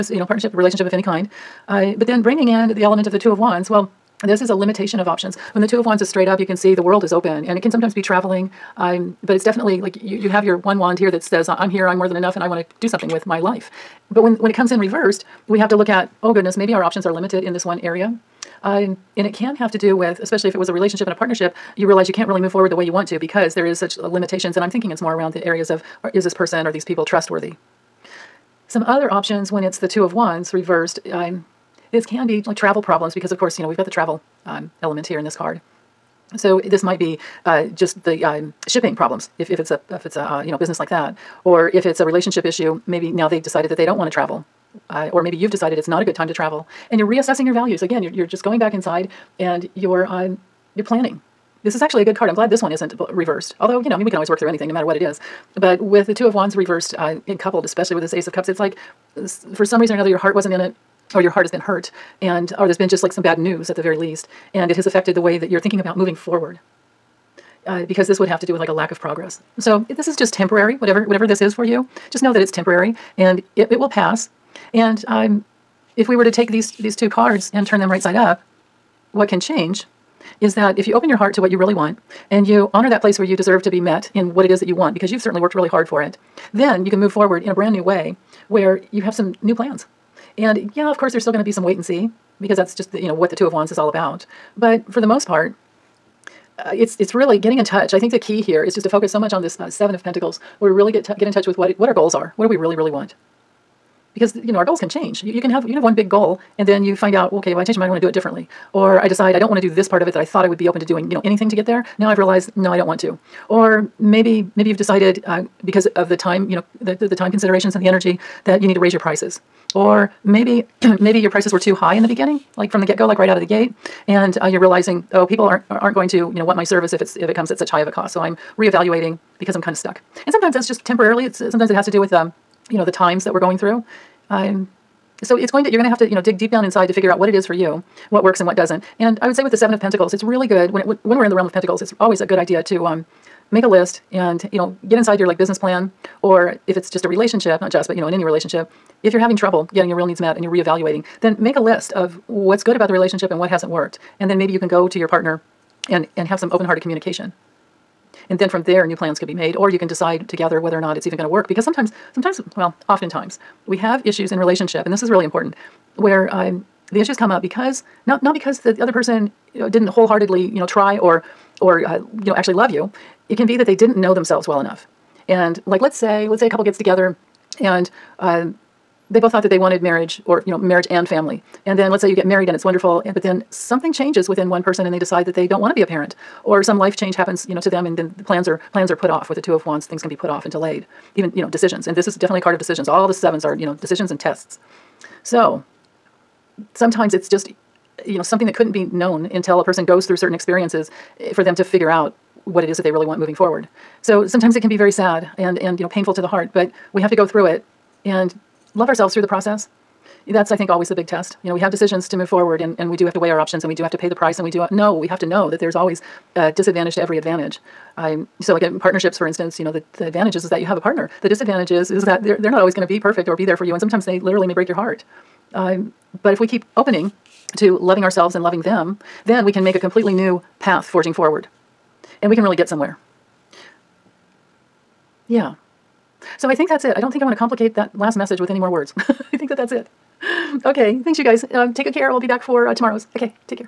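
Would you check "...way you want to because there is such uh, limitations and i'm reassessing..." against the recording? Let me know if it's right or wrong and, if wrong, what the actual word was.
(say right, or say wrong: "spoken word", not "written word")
wrong: "thinking", not "reassessing".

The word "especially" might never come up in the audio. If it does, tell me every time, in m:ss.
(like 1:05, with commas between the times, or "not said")
0:20, 0:57.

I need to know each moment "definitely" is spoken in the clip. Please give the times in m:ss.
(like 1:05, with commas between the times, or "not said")
0:09, 3:12.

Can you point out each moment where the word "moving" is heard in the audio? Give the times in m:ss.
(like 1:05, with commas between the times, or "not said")
1:05, 3:23.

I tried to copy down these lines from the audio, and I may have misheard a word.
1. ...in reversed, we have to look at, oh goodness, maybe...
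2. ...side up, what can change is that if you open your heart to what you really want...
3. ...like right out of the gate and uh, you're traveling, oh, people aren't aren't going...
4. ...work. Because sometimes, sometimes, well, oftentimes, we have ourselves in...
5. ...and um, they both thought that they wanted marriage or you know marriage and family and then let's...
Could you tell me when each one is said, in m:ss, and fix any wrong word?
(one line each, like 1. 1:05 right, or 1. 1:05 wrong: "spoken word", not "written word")
1. 0:14 right
2. 1:18 right
3. 2:03 wrong: "realizing", not "traveling"
4. 2:41 wrong: "issues", not "ourselves"
5. 2:57 right.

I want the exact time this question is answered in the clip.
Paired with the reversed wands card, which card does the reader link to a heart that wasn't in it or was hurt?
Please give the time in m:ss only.
0:58.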